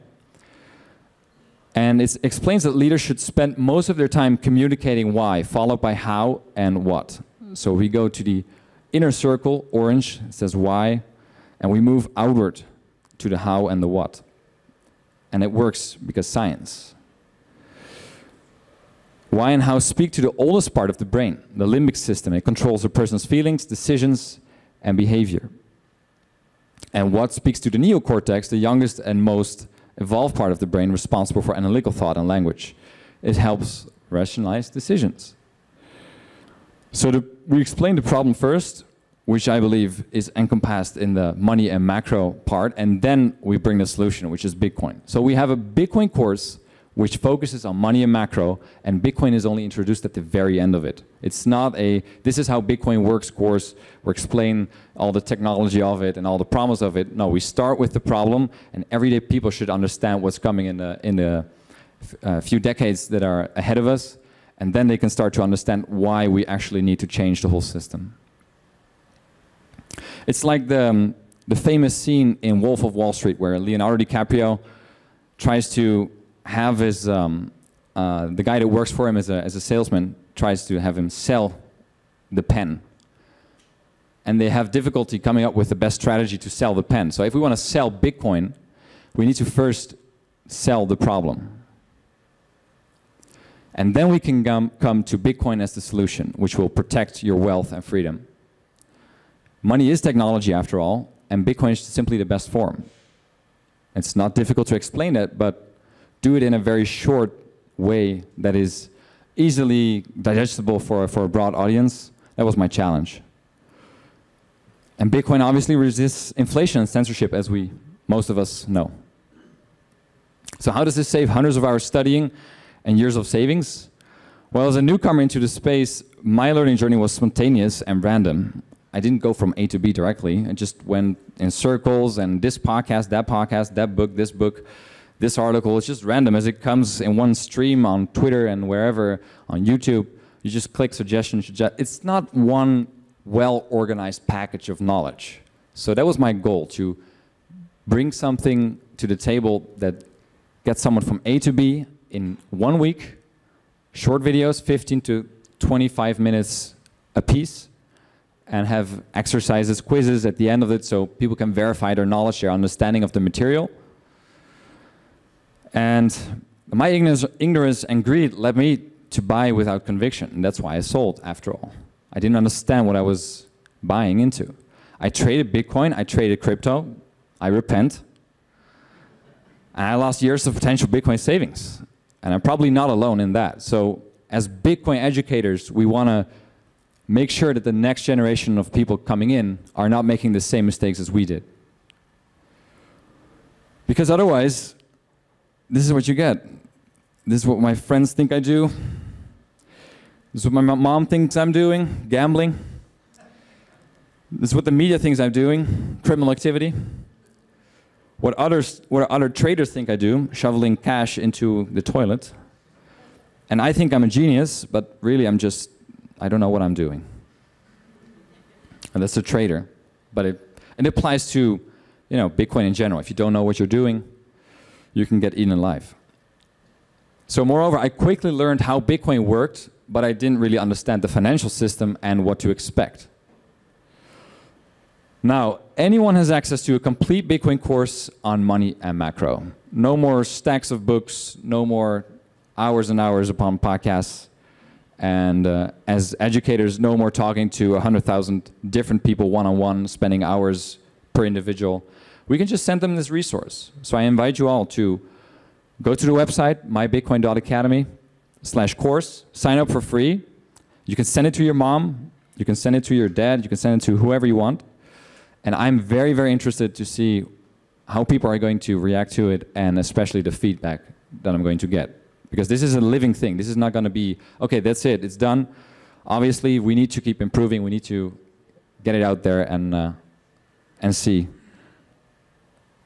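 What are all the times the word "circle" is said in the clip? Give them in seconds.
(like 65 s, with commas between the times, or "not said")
9 s, 131 s.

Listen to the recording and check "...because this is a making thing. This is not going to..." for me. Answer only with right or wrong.
wrong.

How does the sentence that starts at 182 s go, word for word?
And I'm probably not alone in that.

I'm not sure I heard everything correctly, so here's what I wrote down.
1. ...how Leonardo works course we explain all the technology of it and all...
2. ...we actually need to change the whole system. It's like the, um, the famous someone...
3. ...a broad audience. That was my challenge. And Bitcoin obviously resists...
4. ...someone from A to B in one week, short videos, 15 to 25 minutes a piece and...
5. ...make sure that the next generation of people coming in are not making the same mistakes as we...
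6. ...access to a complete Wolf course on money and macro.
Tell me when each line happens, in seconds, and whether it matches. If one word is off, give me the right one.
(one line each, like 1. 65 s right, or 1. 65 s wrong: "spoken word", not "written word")
1. 52 s wrong: "Bitcoin", not "Leonardo"
2. 66 s wrong: "scene", not "someone"
3. 111 s right
4. 150 s right
5. 187 s right
6. 236 s wrong: "Bitcoin", not "Wolf".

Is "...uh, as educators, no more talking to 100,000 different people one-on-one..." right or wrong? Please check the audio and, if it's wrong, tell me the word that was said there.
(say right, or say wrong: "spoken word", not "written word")
right.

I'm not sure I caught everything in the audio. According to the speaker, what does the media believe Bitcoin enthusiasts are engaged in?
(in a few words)
criminal activity.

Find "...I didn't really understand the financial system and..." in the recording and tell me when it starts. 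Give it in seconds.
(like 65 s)
230 s.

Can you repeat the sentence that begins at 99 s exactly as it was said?
Money is technology after all, and Bitcoin is simply the best form.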